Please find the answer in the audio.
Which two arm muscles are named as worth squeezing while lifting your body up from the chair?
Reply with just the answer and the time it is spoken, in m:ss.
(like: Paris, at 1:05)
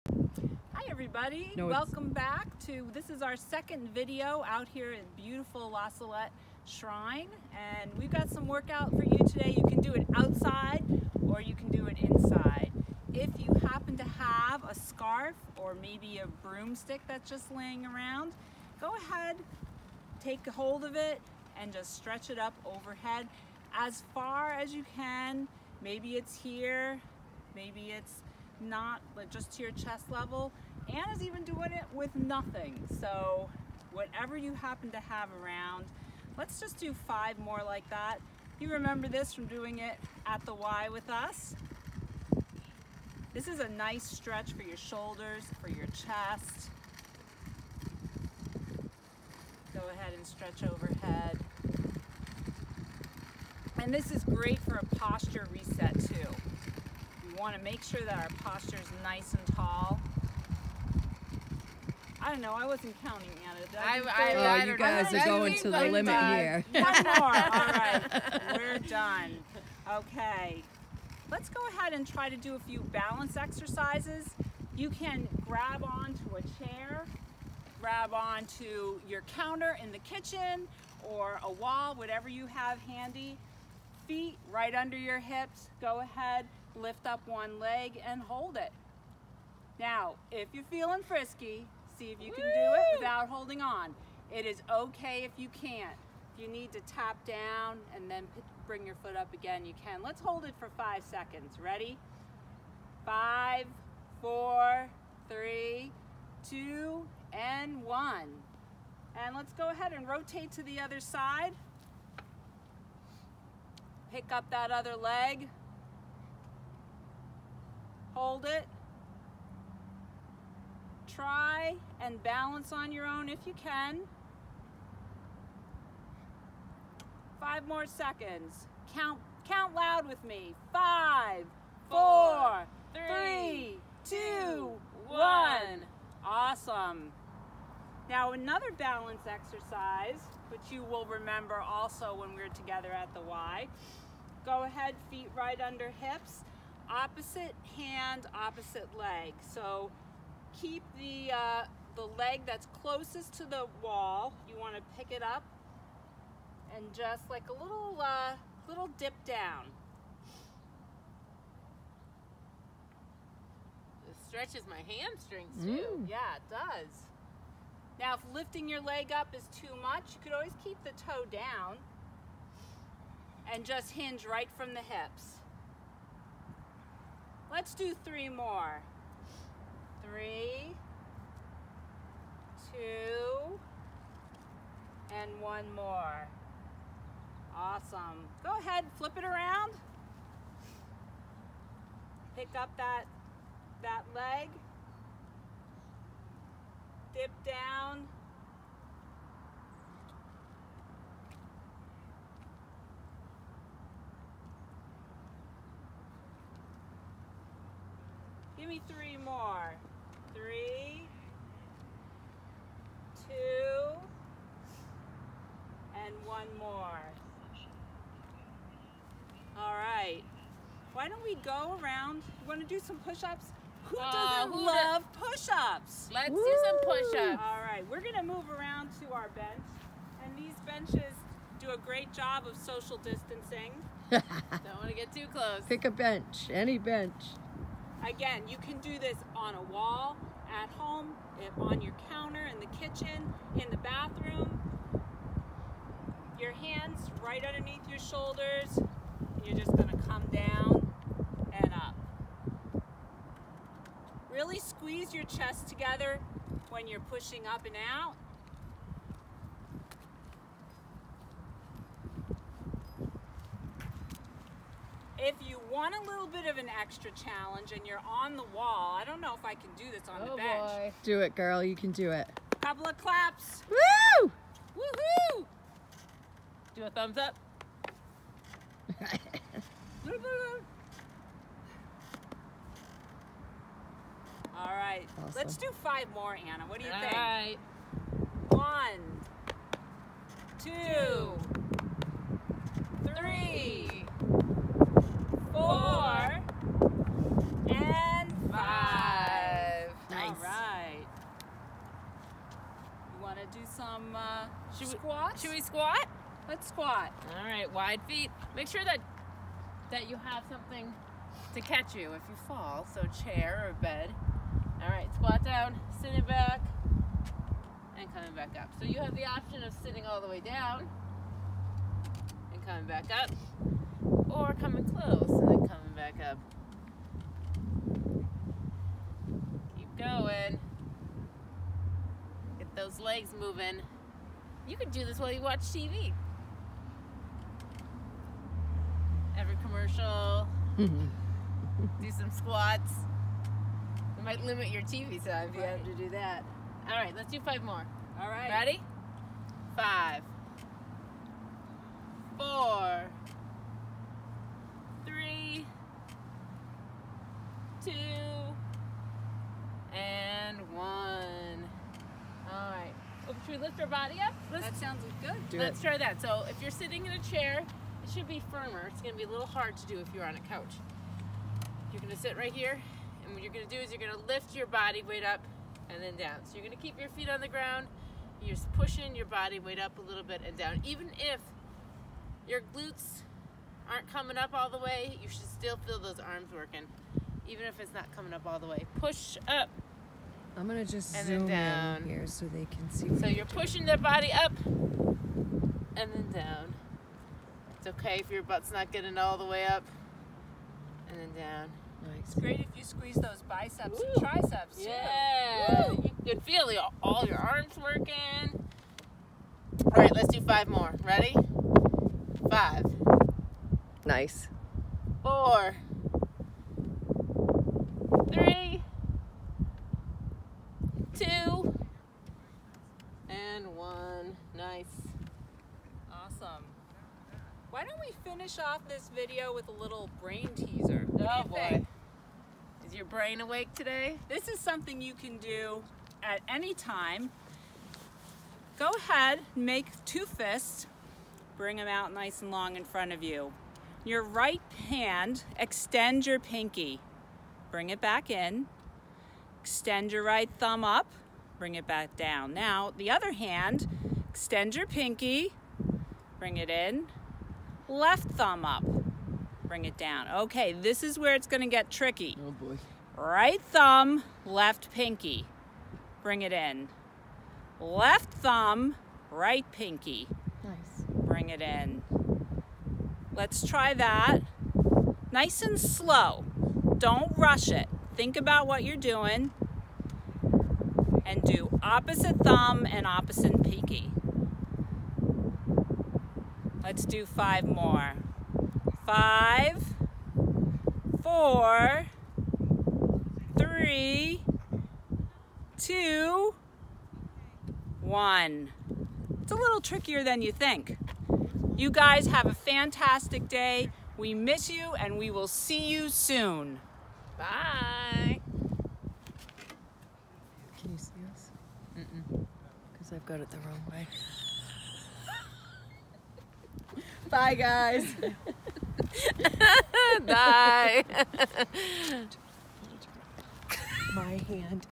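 Biceps and triceps, at 6:43.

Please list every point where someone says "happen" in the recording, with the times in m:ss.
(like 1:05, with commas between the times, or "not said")
0:13, 0:34.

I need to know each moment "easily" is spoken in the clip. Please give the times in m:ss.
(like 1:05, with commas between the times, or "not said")
not said.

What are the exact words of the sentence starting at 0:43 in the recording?
This is a nice stretch for your shoulders, for your chest.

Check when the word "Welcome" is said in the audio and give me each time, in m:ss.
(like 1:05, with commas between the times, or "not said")
0:01.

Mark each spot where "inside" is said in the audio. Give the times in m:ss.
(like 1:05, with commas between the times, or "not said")
0:11.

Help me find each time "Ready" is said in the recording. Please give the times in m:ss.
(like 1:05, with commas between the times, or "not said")
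1:41, 5:48, 6:51.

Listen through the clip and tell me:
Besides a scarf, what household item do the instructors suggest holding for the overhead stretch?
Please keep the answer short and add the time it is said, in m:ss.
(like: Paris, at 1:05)
A broomstick, at 0:16.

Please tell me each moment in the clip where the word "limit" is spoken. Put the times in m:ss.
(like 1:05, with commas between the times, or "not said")
1:05, 5:44.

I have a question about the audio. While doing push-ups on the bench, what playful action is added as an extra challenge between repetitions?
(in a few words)
Claps.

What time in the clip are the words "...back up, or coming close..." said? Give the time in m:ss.
5:22.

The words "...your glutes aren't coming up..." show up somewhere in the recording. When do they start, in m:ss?
6:22.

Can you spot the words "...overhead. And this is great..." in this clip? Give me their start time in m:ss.
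0:50.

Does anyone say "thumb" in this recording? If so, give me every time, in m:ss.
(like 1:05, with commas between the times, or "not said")
4:36, 7:30, 7:38, 7:43, 7:48, 8:02.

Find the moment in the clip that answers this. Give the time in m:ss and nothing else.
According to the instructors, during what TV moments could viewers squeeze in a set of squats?
5:39.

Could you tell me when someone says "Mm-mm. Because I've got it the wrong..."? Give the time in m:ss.
8:31.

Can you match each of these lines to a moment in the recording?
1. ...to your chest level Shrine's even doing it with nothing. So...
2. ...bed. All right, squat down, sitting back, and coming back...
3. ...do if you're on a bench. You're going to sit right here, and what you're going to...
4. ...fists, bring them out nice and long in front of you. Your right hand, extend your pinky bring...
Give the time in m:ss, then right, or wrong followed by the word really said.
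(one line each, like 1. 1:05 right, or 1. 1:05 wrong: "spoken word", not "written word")
1. 0:29 wrong: "Anna", not "Shrine"
2. 5:13 right
3. 6:09 wrong: "couch", not "bench"
4. 7:20 right.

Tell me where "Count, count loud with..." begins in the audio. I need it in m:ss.
2:08.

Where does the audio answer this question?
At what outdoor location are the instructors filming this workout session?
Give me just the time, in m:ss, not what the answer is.
0:05.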